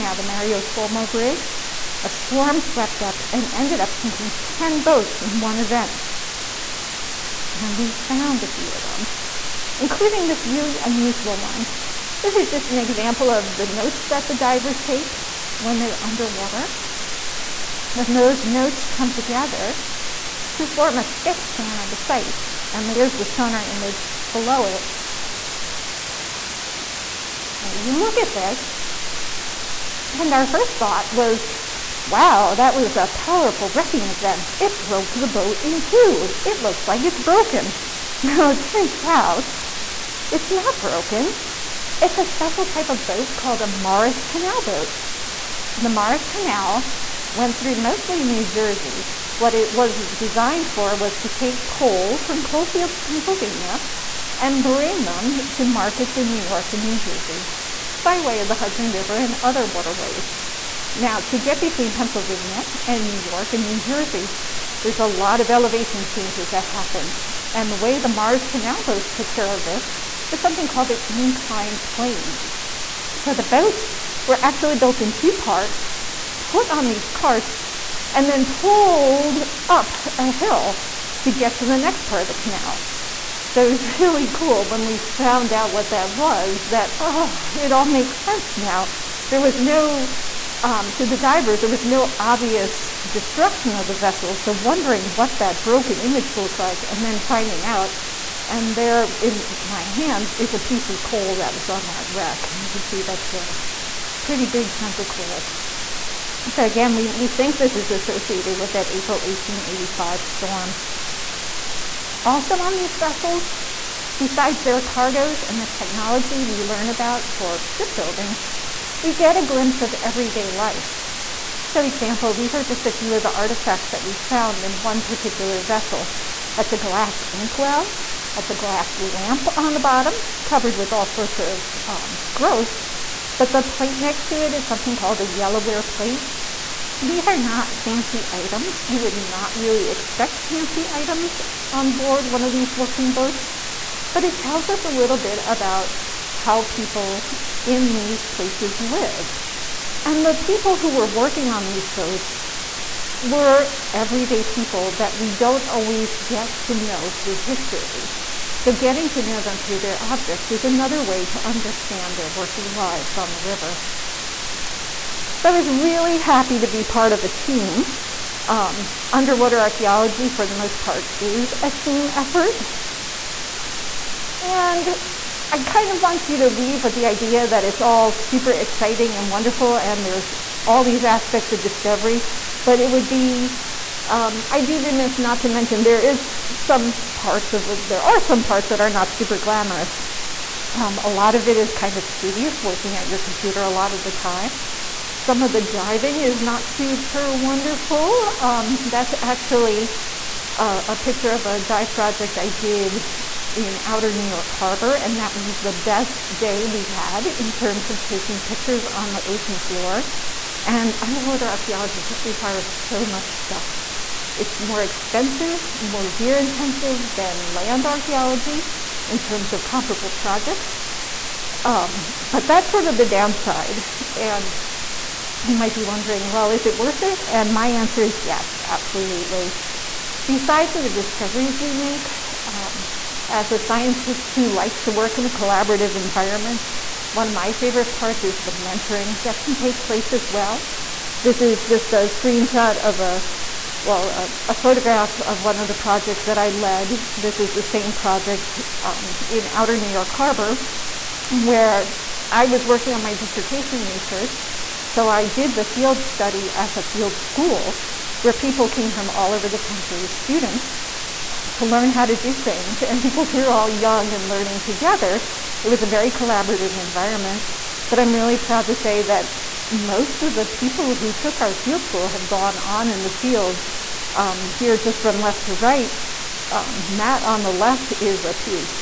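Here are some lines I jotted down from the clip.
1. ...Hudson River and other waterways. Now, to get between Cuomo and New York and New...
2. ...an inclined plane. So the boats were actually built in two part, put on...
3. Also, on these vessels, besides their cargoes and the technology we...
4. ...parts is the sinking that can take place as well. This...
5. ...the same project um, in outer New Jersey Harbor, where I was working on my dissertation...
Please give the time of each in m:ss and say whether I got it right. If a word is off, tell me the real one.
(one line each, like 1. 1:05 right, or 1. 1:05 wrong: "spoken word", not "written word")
1. 0:58 wrong: "Pennsylvania", not "Cuomo"
2. 1:10 right
3. 1:52 right
4. 3:57 wrong: "mentoring", not "sinking"
5. 4:07 wrong: "York", not "Jersey".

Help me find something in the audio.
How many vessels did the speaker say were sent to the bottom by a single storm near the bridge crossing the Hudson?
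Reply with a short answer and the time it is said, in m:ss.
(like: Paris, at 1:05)
10, at 0:04.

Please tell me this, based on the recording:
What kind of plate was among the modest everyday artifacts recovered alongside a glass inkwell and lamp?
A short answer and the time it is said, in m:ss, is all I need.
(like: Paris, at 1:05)
Yellowware plate, at 2:15.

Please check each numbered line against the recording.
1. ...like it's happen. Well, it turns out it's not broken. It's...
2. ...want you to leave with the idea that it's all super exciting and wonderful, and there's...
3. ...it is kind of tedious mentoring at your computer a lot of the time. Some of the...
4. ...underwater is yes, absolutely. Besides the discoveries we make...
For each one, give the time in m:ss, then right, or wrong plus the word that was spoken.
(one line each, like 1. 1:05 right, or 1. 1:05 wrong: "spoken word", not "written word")
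1. 0:36 wrong: "broken", not "happen"
2. 2:56 right
3. 3:11 wrong: "working", not "mentoring"
4. 3:47 wrong: "answer", not "underwater".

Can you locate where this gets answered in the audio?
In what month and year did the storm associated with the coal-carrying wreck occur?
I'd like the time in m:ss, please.
1:48.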